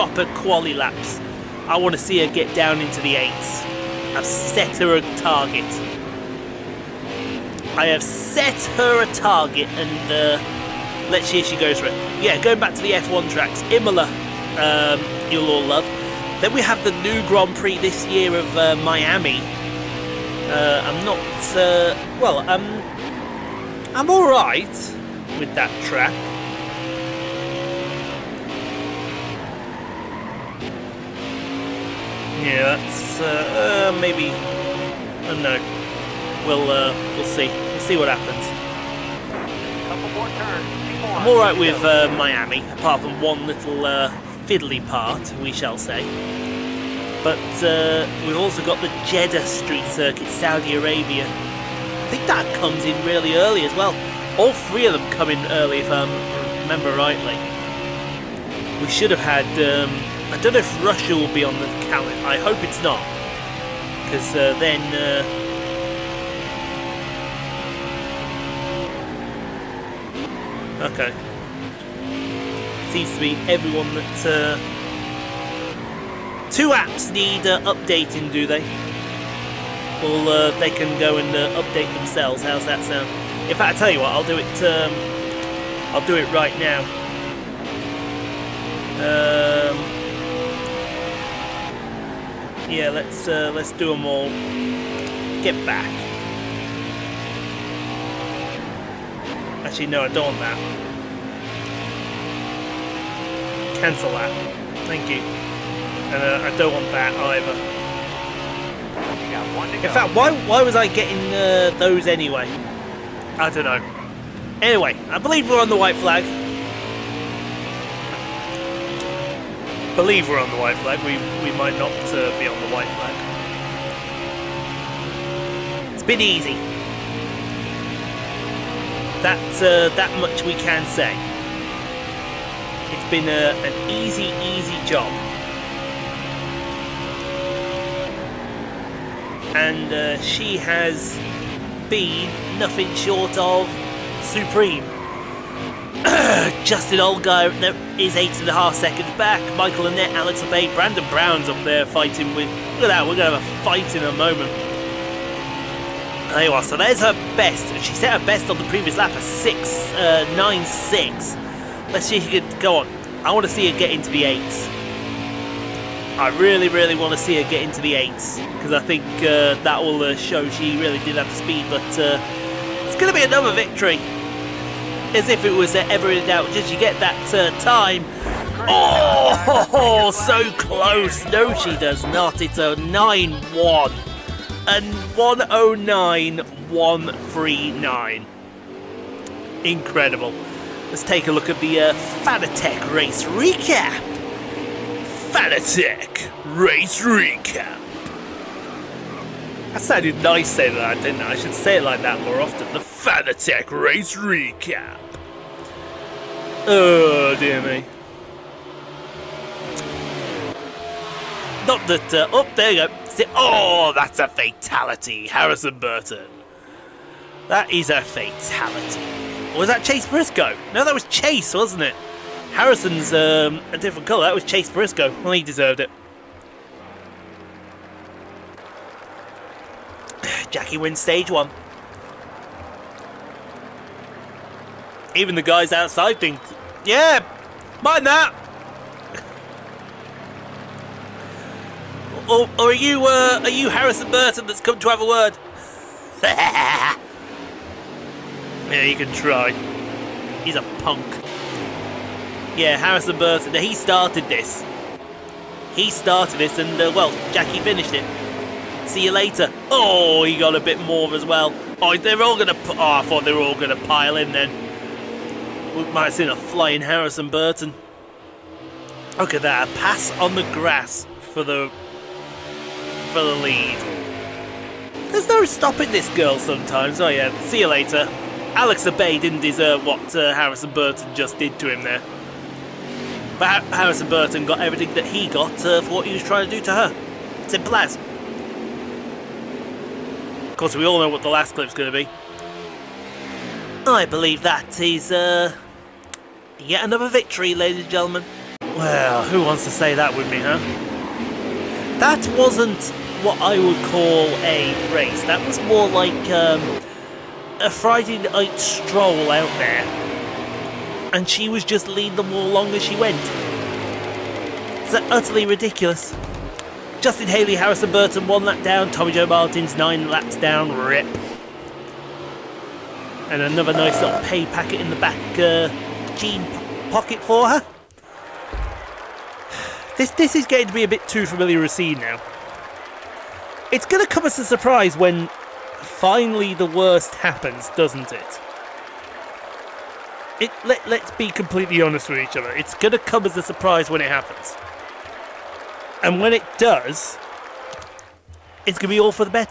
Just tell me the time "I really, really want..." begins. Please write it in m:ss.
2:46.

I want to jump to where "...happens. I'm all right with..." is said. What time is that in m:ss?
0:38.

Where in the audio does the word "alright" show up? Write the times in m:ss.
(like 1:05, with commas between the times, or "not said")
0:24.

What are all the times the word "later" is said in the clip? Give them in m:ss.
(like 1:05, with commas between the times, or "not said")
4:19, 4:37.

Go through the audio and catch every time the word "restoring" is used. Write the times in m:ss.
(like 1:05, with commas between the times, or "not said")
not said.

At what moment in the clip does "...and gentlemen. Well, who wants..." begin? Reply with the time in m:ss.
4:57.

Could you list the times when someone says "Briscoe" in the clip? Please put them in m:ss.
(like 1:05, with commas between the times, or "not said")
3:40, 3:44.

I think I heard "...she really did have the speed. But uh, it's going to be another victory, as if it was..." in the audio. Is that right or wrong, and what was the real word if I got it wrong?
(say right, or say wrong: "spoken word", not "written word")
right.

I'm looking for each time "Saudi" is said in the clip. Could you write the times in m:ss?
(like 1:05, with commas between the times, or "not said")
0:50.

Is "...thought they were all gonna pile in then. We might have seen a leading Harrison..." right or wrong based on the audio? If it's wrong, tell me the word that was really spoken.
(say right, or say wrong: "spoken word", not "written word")
wrong: "flying", not "leading".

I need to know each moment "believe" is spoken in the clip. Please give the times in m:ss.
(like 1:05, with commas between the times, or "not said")
1:55, 1:59, 4:54.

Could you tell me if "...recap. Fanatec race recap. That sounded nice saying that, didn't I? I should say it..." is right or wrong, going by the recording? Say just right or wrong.
right.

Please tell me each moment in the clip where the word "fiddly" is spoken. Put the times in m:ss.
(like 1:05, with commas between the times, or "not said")
0:44.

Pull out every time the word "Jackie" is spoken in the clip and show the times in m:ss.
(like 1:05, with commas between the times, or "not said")
3:50, 4:17.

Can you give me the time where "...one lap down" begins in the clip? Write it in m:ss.
5:18.